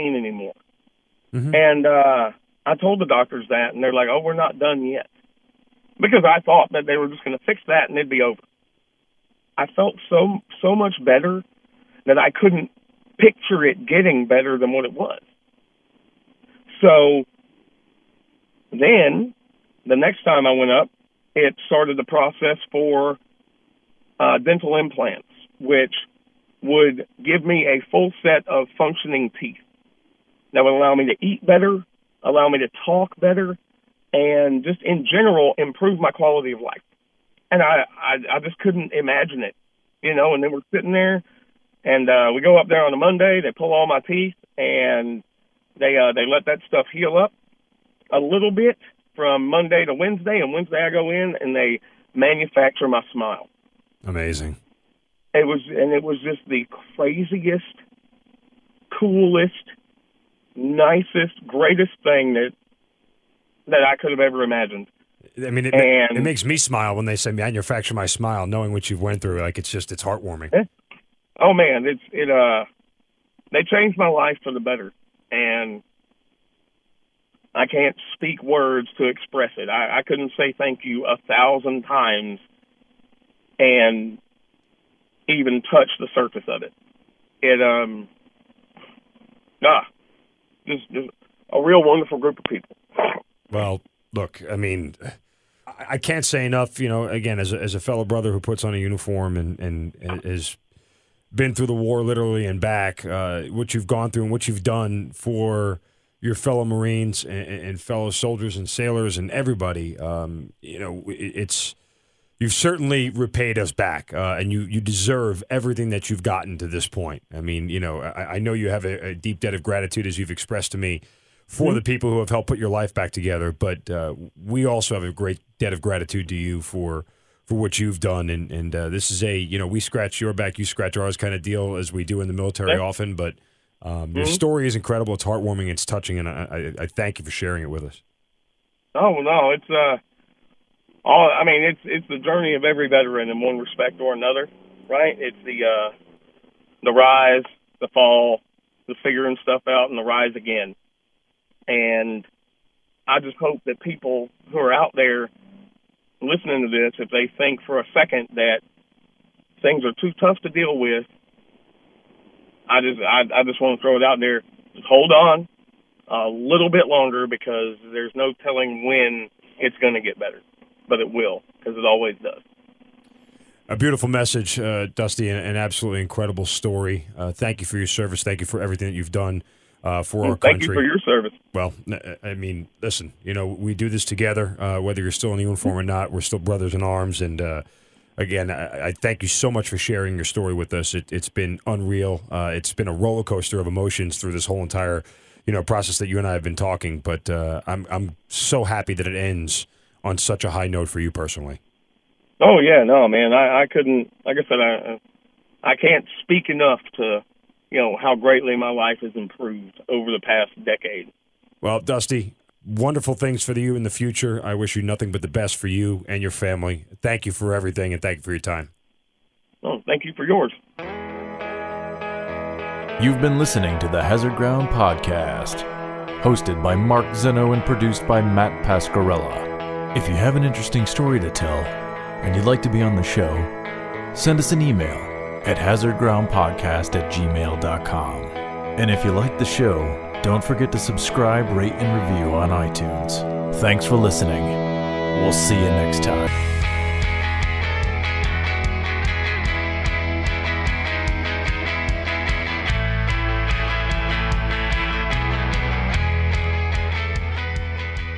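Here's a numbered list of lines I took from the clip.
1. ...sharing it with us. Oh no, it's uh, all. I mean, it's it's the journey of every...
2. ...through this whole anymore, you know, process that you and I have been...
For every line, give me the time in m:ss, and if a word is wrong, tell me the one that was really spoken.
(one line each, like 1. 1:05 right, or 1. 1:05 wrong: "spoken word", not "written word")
1. 2:17 right
2. 3:14 wrong: "entire", not "anymore".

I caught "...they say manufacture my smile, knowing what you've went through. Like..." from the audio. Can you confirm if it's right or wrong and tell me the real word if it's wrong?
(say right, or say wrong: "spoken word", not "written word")
right.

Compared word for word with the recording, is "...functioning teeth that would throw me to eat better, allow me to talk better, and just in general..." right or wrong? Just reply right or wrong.
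wrong.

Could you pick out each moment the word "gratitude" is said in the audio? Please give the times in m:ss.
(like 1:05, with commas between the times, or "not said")
1:59, 2:05.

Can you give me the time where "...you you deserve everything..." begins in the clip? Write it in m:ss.
1:54.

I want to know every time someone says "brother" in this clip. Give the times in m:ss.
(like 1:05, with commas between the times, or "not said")
1:38, 3:06.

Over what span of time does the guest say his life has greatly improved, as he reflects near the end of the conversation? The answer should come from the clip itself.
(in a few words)
the past decade.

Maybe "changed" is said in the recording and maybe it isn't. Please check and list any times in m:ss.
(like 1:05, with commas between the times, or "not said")
1:13.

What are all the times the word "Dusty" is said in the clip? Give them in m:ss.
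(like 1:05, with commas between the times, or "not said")
2:54, 3:31.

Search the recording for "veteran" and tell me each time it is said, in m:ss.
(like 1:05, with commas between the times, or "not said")
2:22.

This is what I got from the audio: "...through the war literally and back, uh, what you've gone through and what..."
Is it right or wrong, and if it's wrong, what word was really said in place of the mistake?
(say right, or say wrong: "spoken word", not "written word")
right.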